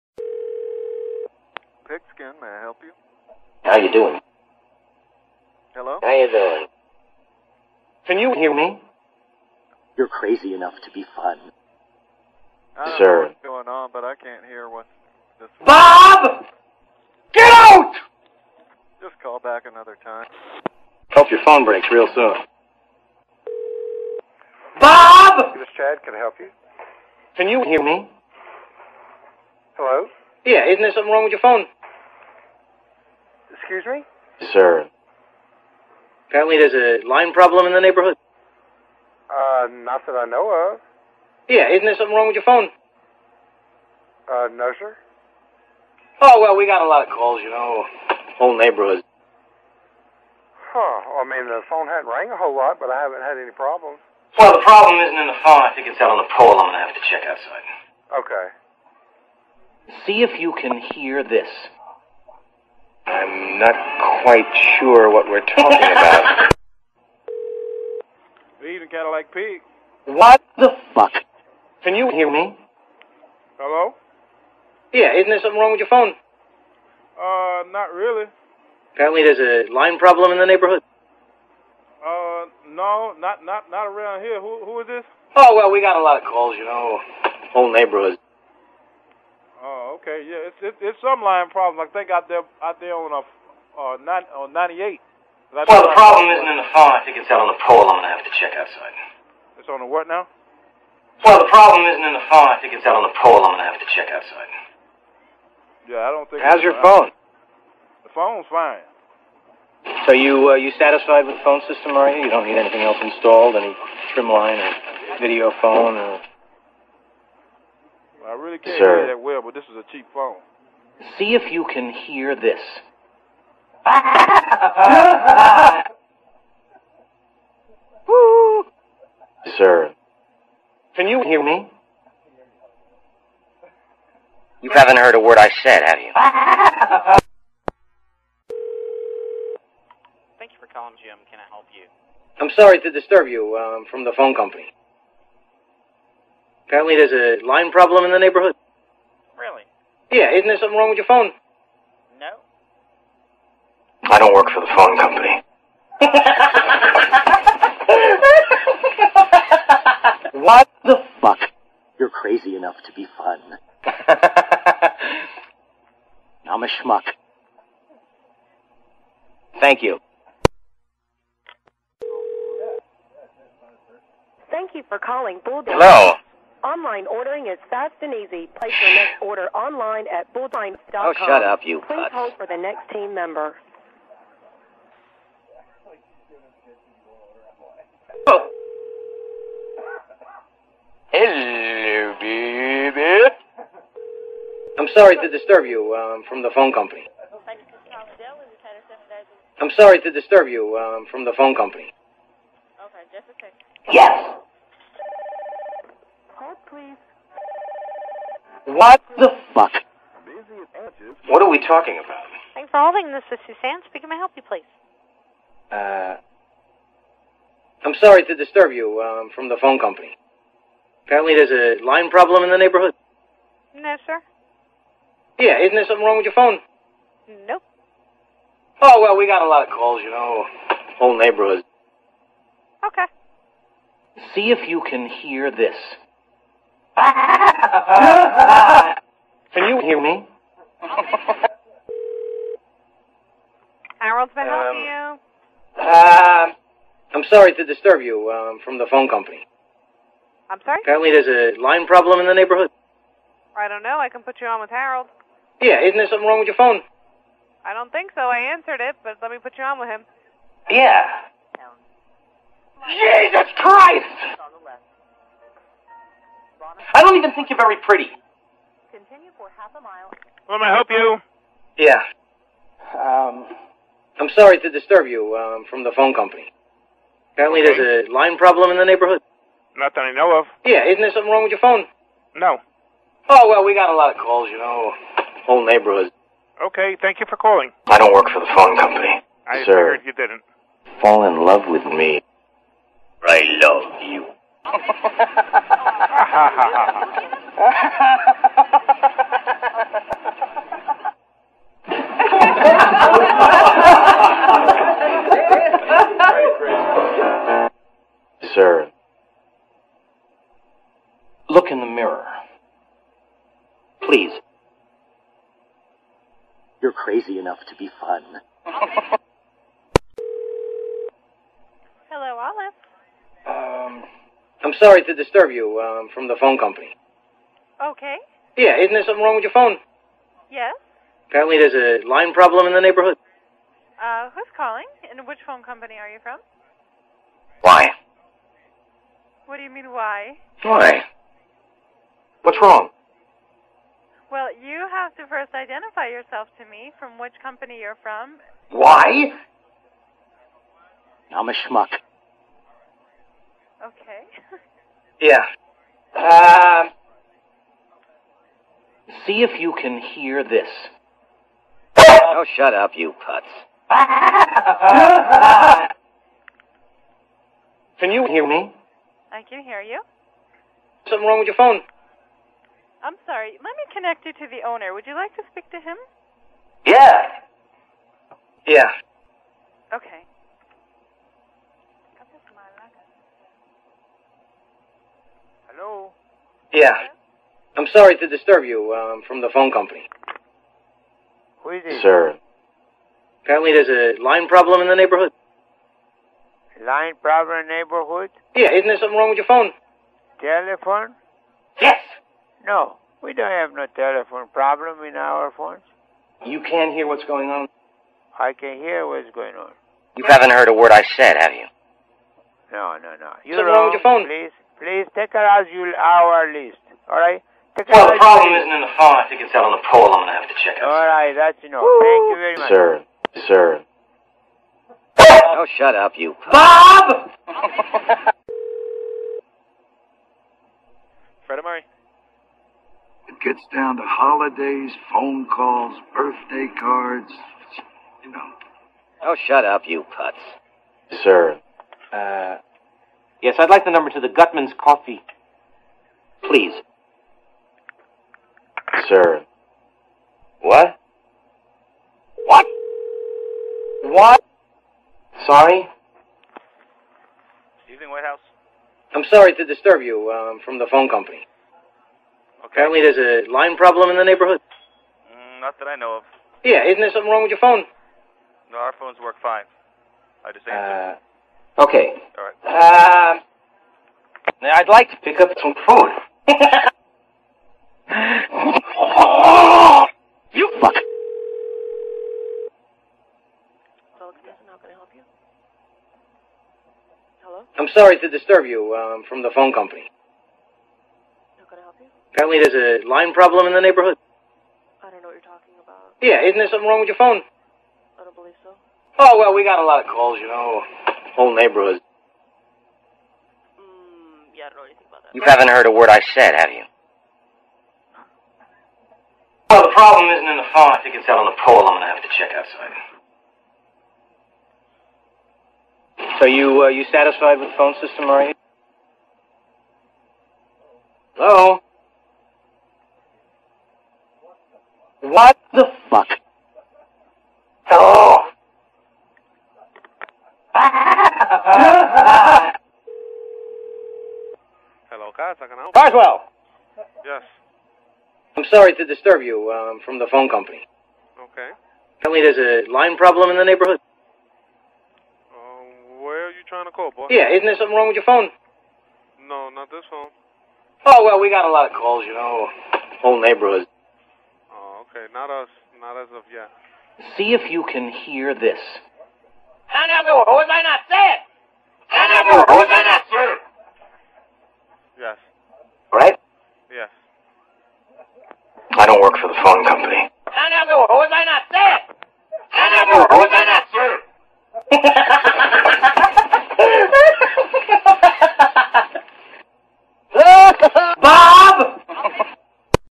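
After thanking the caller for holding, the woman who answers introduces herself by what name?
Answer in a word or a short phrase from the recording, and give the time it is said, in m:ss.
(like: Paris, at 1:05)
Suzanne, at 3:33.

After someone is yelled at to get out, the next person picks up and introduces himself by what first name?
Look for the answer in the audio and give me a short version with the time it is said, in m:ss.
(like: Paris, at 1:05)
Chad, at 0:25.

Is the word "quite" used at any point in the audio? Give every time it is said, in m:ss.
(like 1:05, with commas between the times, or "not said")
1:04.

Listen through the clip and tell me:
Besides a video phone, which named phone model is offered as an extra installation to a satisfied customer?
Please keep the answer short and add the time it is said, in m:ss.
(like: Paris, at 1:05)
Trimline, at 1:54.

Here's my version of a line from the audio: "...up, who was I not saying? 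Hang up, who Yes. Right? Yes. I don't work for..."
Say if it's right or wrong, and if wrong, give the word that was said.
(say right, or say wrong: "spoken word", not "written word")
right.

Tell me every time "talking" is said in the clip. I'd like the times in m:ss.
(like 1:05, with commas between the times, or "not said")
1:05, 3:31, 8:15.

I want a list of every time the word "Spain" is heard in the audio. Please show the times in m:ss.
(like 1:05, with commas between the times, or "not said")
not said.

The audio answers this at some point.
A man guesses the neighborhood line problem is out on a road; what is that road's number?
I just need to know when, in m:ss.
1:34.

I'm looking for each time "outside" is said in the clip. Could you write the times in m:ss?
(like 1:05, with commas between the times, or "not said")
0:57, 1:38, 1:44, 8:32.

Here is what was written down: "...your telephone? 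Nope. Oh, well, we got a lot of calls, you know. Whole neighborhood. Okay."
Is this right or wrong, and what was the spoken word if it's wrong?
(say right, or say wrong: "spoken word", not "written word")
wrong: "phone", not "telephone".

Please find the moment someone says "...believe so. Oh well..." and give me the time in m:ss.
8:18.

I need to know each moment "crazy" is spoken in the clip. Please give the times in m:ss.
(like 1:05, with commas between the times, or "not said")
0:10, 2:42, 5:16.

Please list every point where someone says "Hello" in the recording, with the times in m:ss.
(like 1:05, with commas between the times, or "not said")
0:05, 0:29, 1:13, 2:55, 3:11, 8:07, 8:41, 8:47.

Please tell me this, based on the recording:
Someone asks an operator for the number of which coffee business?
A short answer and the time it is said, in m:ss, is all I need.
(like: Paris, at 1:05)
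Gutman's Coffee, at 7:24.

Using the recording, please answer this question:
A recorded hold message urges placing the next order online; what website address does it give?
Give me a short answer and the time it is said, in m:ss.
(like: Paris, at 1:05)
bullseye.com, at 3:00.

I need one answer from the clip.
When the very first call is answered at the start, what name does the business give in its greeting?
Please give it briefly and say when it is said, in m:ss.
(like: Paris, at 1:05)
Pigskin, at 0:01.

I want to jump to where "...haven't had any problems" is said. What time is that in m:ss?
0:52.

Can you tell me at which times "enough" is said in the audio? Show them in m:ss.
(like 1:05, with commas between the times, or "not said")
0:10, 2:42, 5:17, 7:01.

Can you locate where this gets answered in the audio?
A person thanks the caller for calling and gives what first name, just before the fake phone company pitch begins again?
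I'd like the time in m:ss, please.
2:21.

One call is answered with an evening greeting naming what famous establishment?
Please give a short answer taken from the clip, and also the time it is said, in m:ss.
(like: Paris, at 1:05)
White House, at 7:38.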